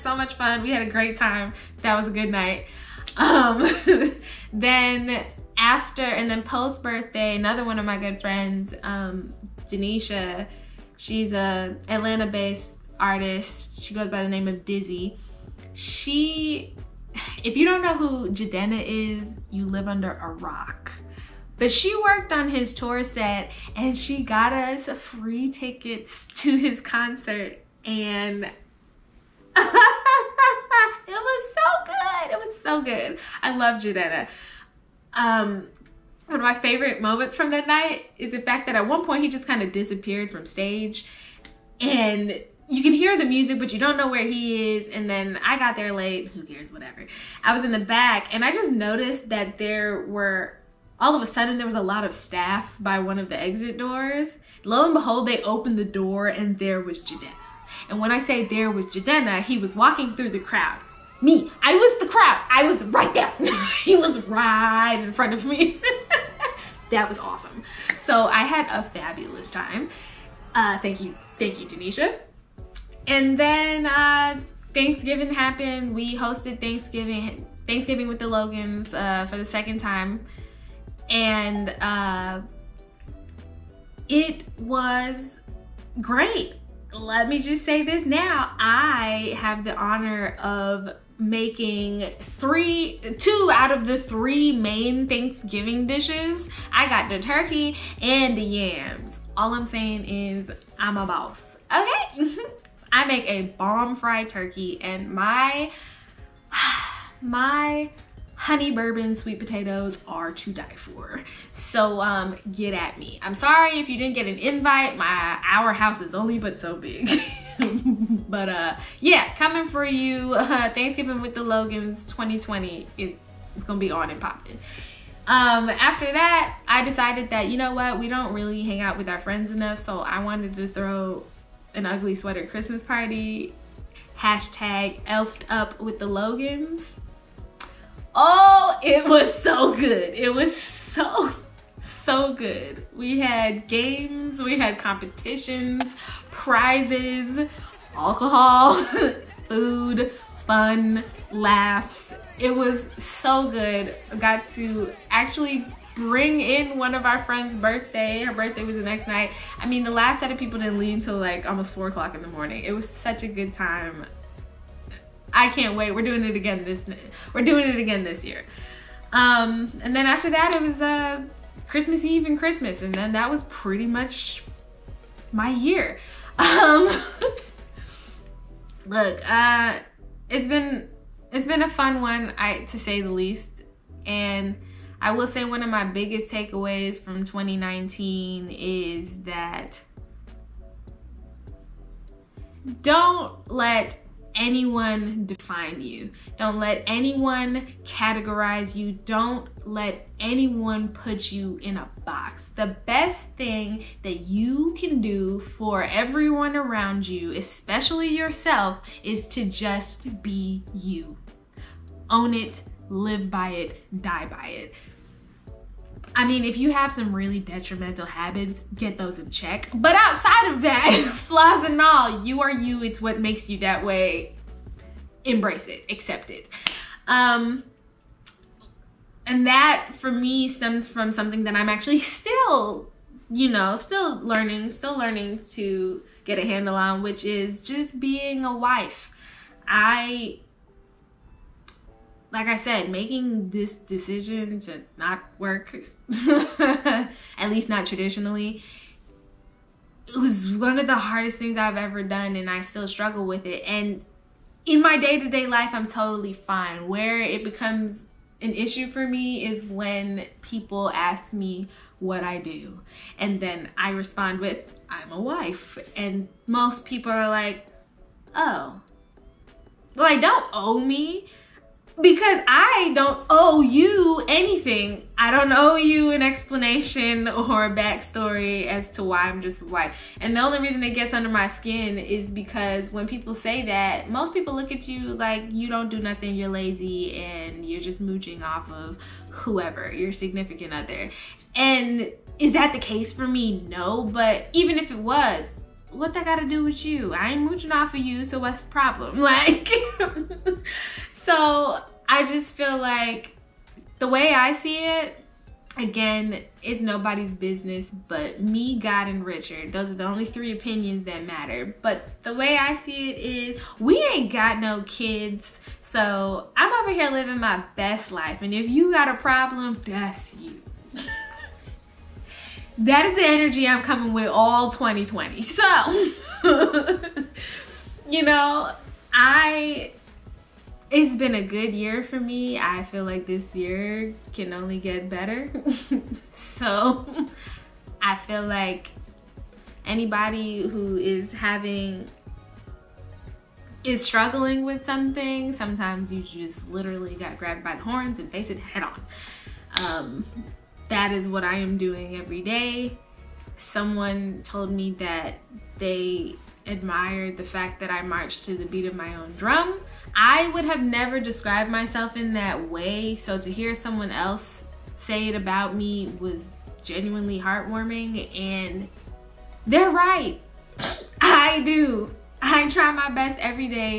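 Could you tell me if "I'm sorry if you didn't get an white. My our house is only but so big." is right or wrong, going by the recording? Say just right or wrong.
wrong.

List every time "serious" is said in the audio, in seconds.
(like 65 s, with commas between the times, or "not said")
not said.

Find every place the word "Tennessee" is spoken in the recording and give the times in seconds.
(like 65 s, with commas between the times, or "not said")
not said.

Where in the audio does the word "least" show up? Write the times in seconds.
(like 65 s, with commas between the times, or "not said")
183 s, 247 s.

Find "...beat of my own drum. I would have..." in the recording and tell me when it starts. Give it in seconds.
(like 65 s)
358 s.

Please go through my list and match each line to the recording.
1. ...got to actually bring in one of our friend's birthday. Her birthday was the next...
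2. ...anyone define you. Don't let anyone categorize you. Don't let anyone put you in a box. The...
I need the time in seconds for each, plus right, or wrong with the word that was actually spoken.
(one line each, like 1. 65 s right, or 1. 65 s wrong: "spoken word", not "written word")
1. 154 s right
2. 194 s right.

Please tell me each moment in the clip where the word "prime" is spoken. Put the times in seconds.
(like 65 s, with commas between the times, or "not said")
not said.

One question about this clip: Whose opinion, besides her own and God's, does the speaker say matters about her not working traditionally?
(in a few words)
Richard.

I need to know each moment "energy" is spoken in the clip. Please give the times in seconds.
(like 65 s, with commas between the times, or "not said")
323 s.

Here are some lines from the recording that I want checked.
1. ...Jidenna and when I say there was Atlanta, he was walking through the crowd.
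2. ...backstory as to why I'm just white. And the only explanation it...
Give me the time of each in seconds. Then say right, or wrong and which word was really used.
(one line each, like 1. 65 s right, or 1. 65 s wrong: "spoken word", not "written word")
1. 57 s wrong: "Jidenna", not "Atlanta"
2. 277 s wrong: "reason", not "explanation".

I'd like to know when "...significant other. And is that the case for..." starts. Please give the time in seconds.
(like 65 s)
290 s.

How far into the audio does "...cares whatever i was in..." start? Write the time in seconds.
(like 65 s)
46 s.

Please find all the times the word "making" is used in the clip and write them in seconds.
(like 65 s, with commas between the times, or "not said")
91 s, 242 s.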